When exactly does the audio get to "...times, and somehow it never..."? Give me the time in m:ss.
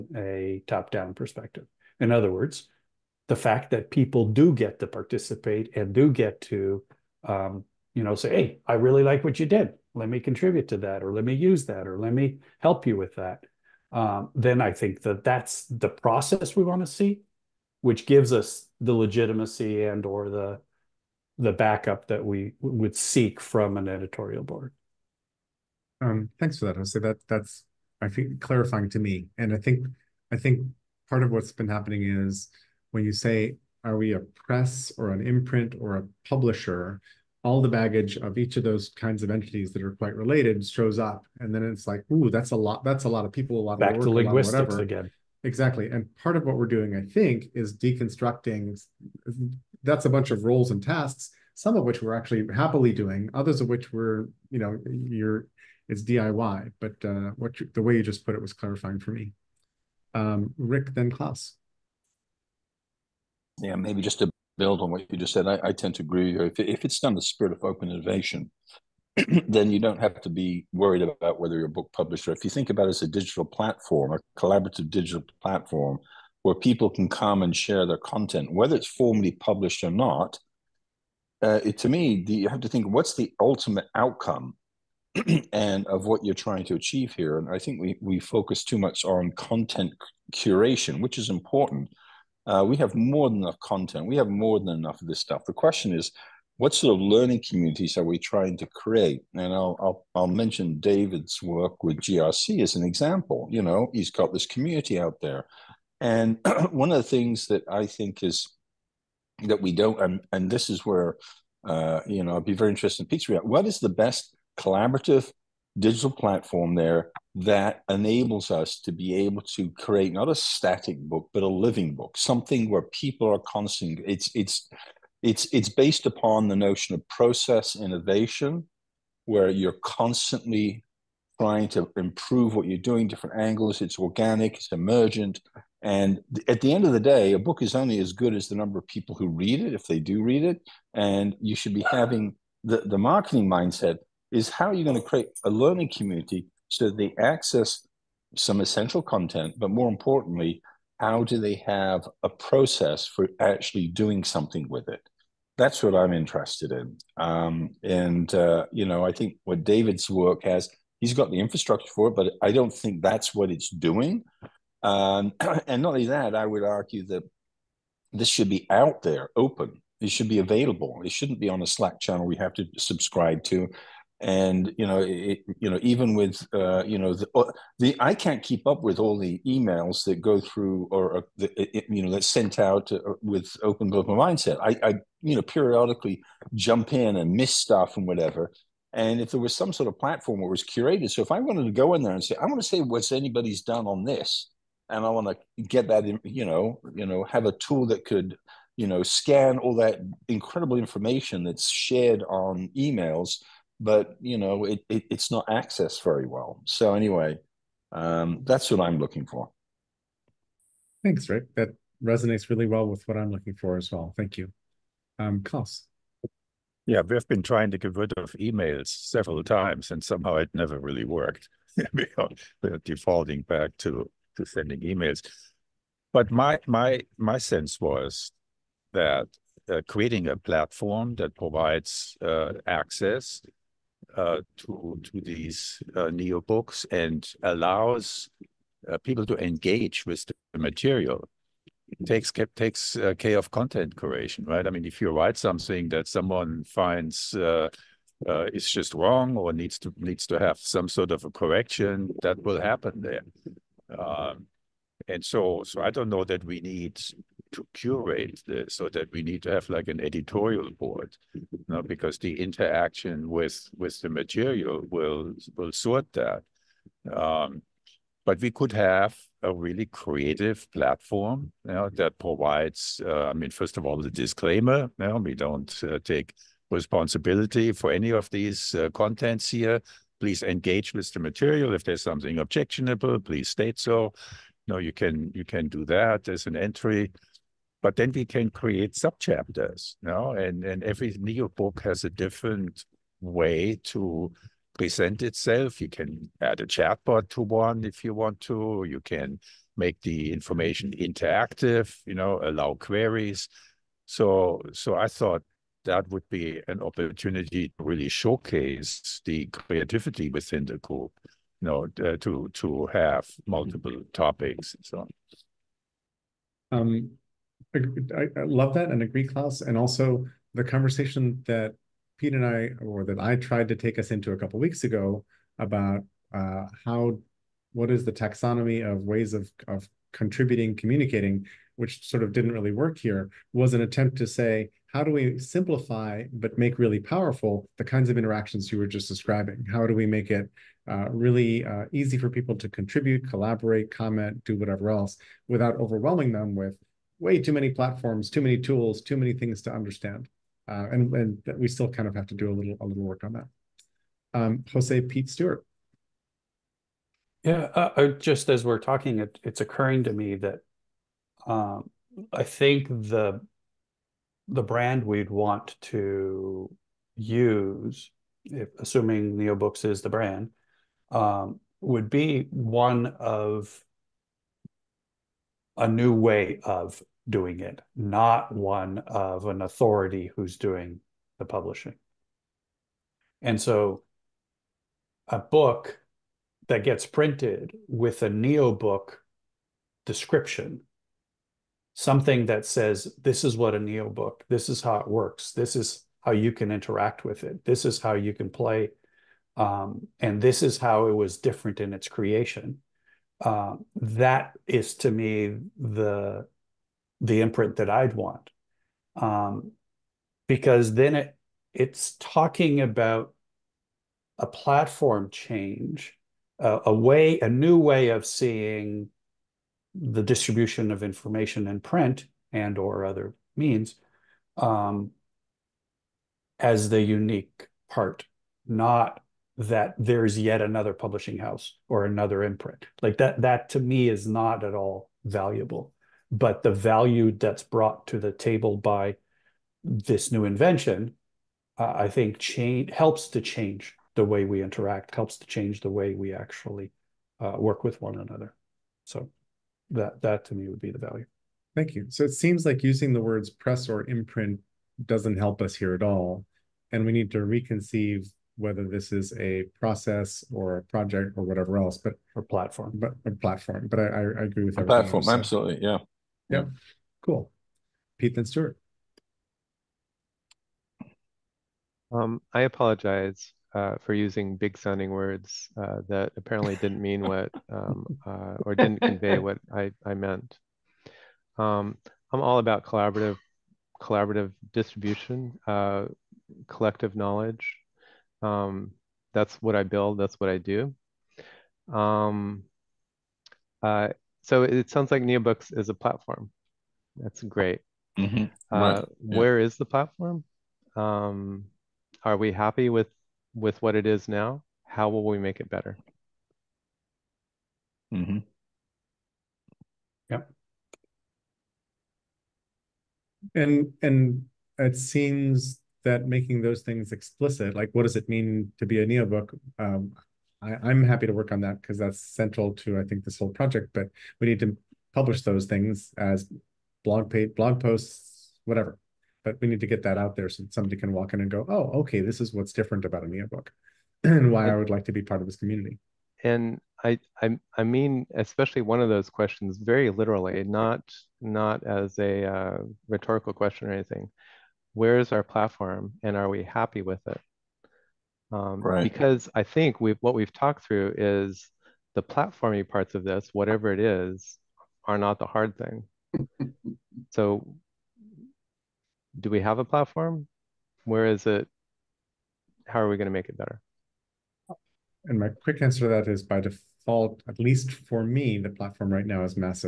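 3:39.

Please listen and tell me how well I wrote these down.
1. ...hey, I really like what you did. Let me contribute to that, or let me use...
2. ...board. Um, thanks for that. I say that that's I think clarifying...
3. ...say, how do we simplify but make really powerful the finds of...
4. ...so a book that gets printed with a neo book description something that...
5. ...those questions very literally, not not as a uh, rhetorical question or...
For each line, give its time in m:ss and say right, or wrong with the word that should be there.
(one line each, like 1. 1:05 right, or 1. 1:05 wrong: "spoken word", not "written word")
1. 0:08 right
2. 0:24 right
3. 5:34 wrong: "kinds", not "finds"
4. 6:23 right
5. 8:59 right.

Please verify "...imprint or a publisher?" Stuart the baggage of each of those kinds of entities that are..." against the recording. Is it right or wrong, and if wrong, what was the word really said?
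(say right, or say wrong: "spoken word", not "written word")
wrong: "All", not "Stuart".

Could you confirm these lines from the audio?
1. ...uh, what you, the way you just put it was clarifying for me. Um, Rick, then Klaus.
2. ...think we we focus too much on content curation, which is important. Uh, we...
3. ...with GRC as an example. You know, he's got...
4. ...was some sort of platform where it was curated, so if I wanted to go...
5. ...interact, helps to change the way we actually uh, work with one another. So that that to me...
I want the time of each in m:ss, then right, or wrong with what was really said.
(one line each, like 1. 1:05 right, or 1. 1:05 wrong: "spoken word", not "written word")
1. 0:57 right
2. 1:27 right
3. 1:41 right
4. 3:09 right
5. 7:24 right.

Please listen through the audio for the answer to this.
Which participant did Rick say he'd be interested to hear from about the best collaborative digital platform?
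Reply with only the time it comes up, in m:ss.
1:53.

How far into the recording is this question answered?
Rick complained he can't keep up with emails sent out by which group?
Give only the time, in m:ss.
3:03.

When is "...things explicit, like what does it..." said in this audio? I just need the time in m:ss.
8:36.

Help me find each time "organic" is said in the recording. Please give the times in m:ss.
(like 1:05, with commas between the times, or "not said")
2:13.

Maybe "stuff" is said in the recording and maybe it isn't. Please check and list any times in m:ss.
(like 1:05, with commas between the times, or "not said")
1:35, 3:07.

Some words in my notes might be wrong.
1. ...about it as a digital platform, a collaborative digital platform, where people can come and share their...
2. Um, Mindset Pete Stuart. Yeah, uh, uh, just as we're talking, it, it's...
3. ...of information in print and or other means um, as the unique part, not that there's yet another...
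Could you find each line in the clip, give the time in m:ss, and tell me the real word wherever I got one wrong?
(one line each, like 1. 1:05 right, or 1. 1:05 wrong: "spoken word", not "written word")
1. 1:12 right
2. 5:54 wrong: "Jose", not "Mindset"
3. 7:00 right.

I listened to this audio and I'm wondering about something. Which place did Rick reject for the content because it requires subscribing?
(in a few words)
A Slack channel.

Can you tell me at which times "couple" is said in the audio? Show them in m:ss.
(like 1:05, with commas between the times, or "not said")
5:24.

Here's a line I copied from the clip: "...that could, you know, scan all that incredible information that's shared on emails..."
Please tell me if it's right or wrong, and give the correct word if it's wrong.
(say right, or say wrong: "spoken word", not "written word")
right.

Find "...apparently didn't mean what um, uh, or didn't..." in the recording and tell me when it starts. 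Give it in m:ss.
7:56.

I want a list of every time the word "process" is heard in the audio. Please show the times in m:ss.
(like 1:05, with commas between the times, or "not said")
0:15, 2:07, 2:32, 7:39.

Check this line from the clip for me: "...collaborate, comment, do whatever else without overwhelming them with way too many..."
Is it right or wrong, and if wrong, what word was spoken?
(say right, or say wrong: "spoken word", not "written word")
right.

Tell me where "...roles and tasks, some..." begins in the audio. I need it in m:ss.
0:50.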